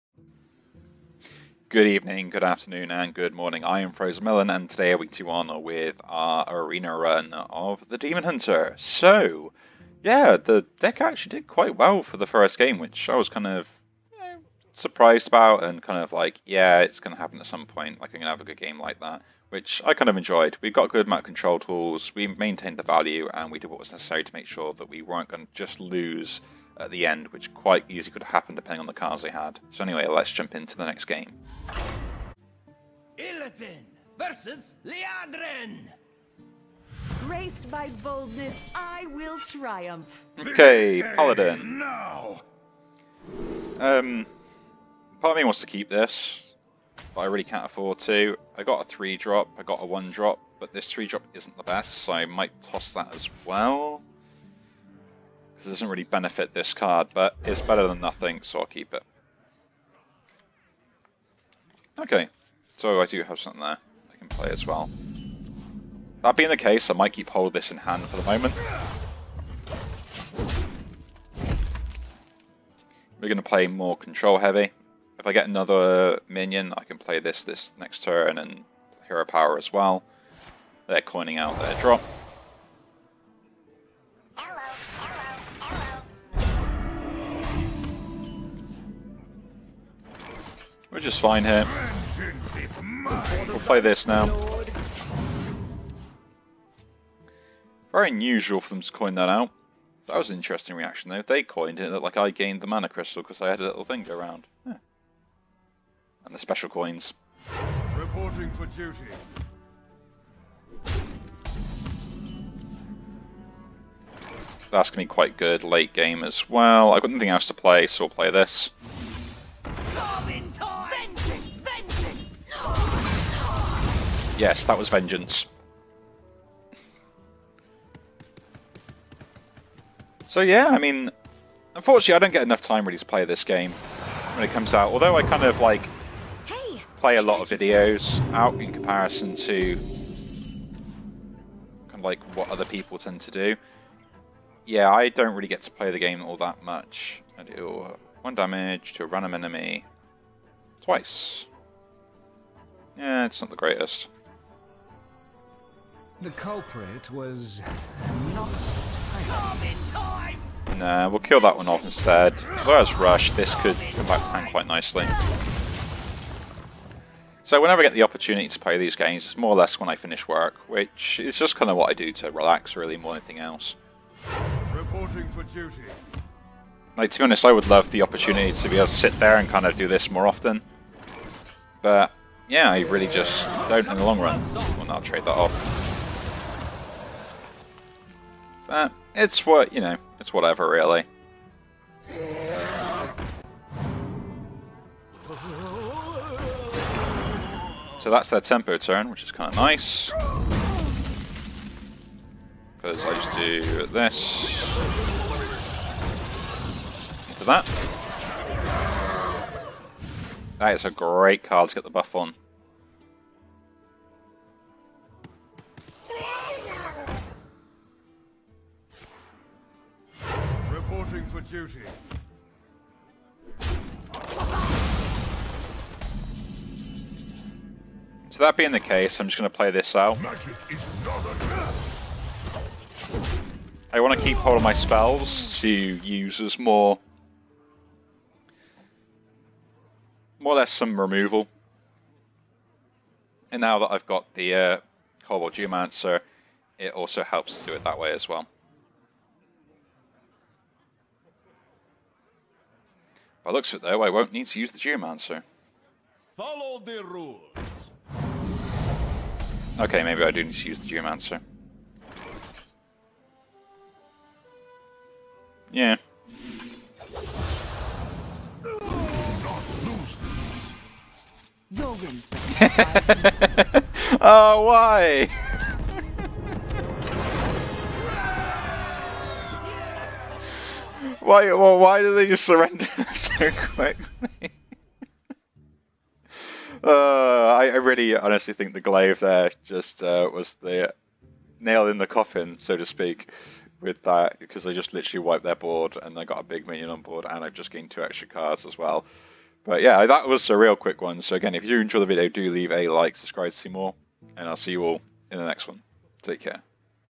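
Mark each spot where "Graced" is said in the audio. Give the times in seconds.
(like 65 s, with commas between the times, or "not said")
37 s.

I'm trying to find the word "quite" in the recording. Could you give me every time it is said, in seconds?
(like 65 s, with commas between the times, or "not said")
11 s, 27 s, 115 s, 164 s.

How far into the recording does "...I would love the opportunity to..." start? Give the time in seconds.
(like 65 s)
177 s.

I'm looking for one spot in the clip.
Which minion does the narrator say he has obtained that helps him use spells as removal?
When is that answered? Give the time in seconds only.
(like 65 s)
245 s.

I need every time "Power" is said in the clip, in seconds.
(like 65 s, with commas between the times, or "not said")
79 s.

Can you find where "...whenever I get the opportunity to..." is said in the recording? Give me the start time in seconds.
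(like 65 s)
167 s.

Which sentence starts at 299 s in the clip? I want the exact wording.
But yeah, that was a real quick one.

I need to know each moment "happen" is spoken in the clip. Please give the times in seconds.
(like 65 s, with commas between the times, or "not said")
17 s, 28 s.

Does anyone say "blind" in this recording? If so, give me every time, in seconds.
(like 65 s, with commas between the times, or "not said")
not said.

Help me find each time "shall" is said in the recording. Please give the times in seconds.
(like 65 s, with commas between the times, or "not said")
not said.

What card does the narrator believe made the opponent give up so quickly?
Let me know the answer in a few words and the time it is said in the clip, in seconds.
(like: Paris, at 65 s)
The glaive, at 288 s.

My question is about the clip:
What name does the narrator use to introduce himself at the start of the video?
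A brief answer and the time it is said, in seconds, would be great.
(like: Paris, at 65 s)
Frozen Melon, at 3 s.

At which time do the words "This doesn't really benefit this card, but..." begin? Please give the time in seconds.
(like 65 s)
55 s.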